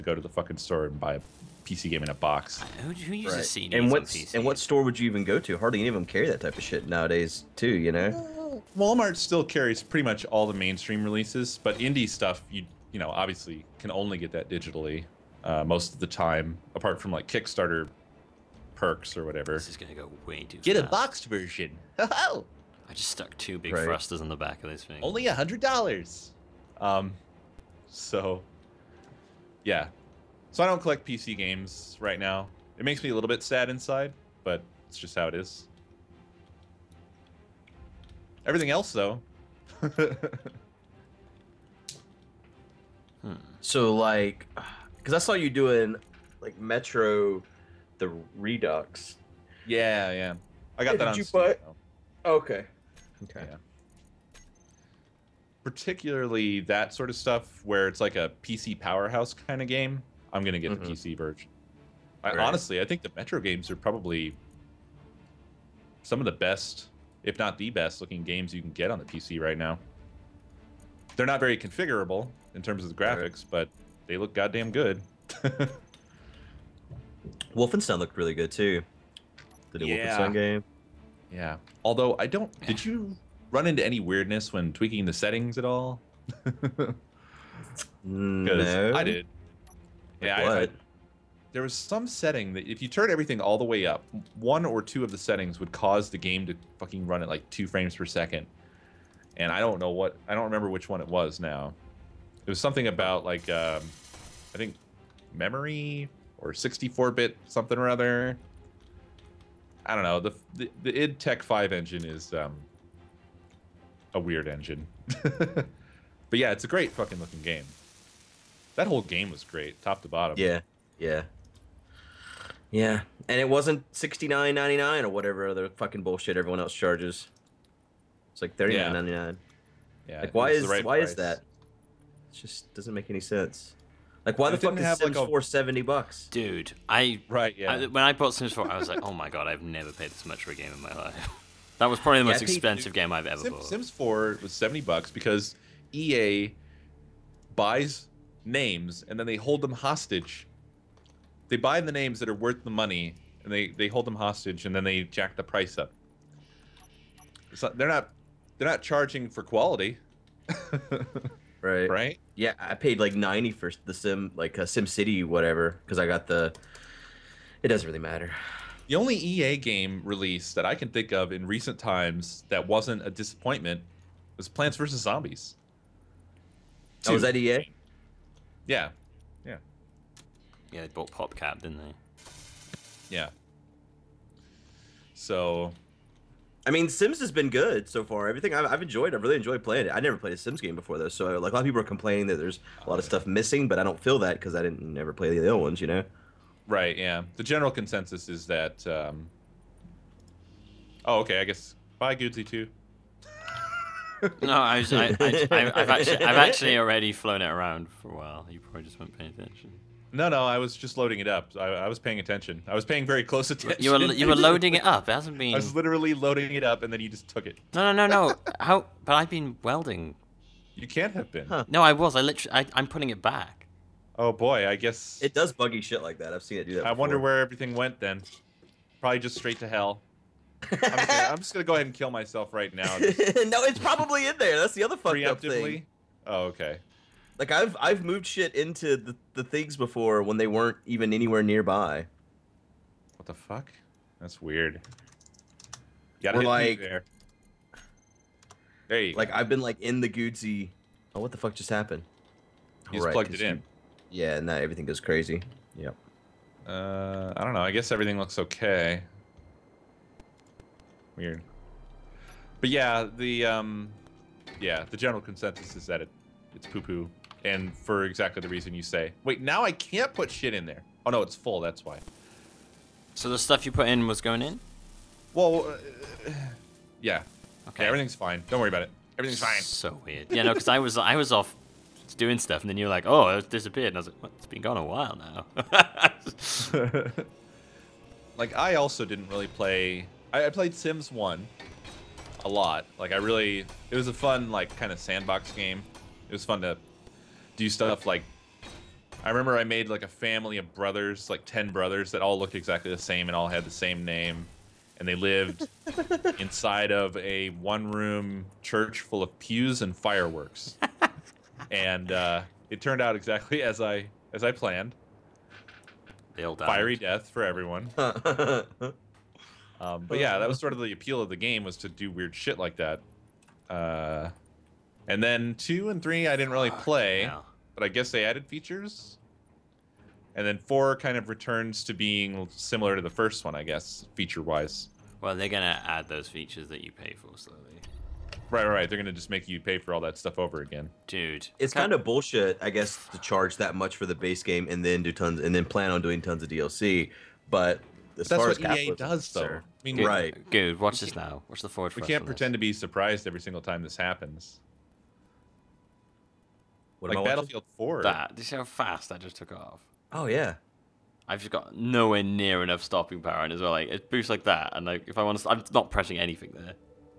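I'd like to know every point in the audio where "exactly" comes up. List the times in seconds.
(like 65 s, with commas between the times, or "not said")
268 s, 302 s, 313 s.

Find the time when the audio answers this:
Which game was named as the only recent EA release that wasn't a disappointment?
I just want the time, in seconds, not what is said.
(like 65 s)
174 s.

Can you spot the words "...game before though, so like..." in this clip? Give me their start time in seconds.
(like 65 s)
190 s.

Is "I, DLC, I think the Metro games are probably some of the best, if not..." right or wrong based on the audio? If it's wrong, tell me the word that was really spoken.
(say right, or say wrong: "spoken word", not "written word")
wrong: "Honestly", not "DLC".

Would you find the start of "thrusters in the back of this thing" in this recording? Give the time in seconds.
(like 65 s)
23 s.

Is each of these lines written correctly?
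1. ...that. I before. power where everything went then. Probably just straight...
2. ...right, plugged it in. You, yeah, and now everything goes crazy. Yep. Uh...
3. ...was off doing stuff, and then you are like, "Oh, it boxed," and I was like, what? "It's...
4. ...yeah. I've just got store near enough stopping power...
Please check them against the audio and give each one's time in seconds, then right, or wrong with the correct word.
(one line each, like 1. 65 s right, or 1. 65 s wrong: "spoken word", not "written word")
1. 226 s wrong: "wonder", not "power"
2. 253 s right
3. 281 s wrong: "disappeared", not "boxed"
4. 360 s wrong: "nowhere", not "store".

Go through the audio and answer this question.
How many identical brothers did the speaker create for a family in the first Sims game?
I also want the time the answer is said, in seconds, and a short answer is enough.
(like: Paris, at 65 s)
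10, at 301 s.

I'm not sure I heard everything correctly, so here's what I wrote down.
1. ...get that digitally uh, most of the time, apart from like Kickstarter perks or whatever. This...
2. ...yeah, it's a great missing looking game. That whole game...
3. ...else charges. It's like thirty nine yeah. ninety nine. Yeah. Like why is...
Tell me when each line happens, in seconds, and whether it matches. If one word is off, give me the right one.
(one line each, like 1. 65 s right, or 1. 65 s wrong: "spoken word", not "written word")
1. 14 s right
2. 116 s wrong: "fucking", not "missing"
3. 126 s right.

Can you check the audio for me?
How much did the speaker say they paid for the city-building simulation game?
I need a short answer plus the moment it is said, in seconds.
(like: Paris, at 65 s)
$90, at 163 s.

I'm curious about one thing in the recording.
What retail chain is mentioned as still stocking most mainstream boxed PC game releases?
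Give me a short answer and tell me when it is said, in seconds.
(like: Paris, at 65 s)
Walmart, at 8 s.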